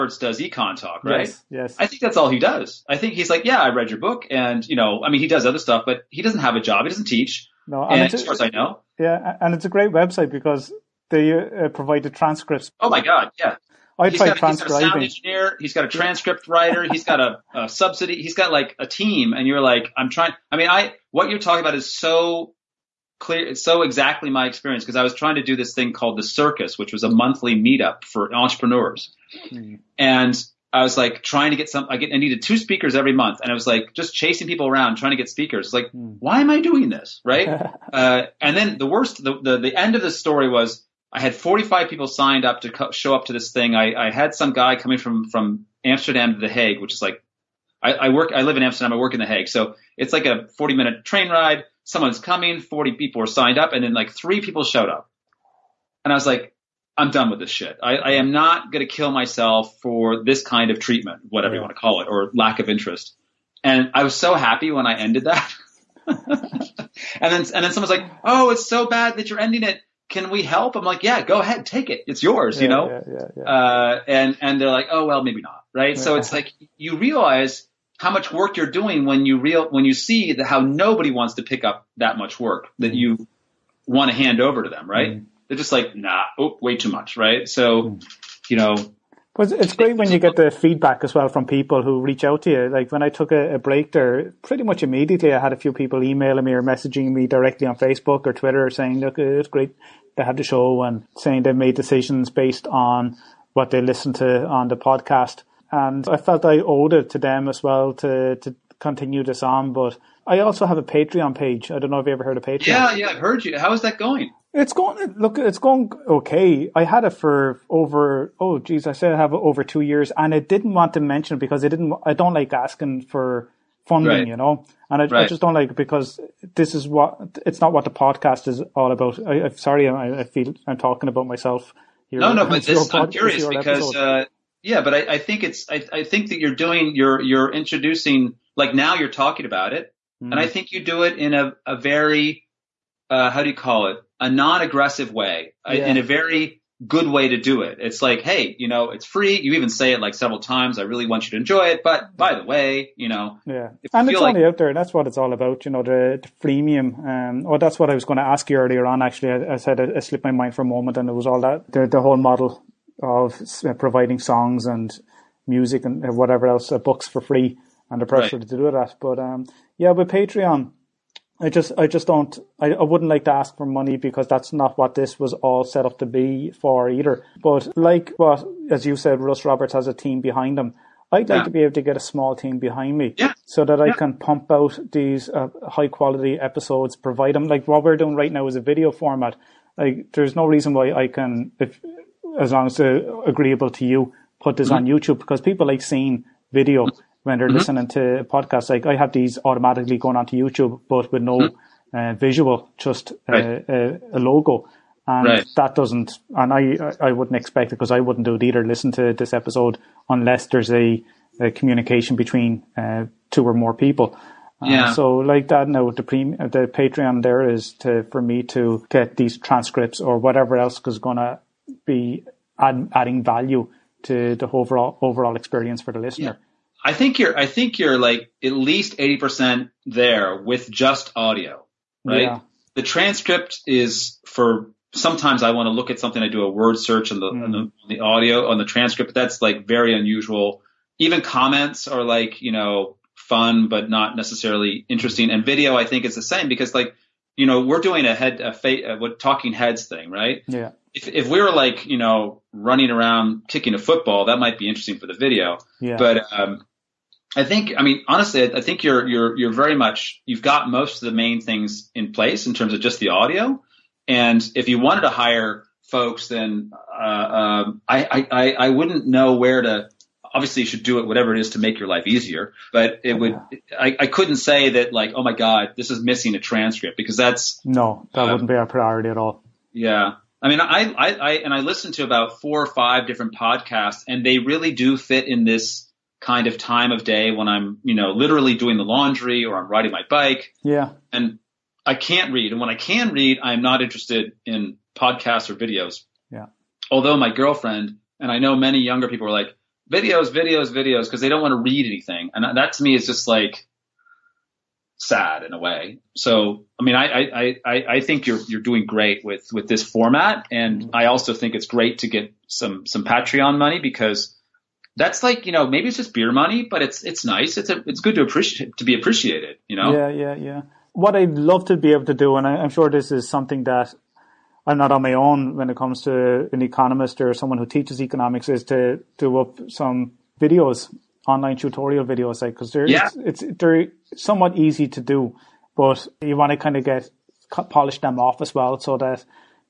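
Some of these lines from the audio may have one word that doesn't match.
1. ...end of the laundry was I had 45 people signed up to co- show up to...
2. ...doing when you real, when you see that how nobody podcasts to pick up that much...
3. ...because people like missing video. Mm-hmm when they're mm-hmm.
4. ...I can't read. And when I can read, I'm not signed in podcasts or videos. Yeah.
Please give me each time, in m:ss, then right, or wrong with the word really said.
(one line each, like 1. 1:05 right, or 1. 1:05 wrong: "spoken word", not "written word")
1. 0:39 wrong: "story", not "laundry"
2. 1:18 wrong: "wants", not "podcasts"
3. 3:15 wrong: "seeing", not "missing"
4. 4:51 wrong: "interested", not "signed".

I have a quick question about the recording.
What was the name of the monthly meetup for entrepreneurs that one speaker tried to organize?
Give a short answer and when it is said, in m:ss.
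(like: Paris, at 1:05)
the Circus, at 0:26.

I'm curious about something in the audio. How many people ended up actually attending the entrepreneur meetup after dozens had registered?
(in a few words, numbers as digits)
3.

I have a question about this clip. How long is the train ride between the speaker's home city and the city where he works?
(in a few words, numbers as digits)
40 minutes.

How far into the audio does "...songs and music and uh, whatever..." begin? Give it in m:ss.
2:44.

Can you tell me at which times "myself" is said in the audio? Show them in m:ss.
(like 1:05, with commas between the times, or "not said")
0:59, 2:11.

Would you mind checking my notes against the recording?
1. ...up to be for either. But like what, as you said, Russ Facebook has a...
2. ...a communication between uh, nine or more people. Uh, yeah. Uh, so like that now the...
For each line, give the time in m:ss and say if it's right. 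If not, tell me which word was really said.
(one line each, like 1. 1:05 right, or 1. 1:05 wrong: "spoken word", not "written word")
1. 2:55 wrong: "Roberts", not "Facebook"
2. 3:31 wrong: "two", not "nine".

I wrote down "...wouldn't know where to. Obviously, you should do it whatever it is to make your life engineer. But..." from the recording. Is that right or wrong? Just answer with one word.
wrong.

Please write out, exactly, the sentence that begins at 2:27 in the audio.
It's like, hey, you know, it's free.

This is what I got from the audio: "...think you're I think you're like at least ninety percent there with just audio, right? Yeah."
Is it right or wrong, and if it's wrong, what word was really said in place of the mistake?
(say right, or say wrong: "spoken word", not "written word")
wrong: "eighty", not "ninety".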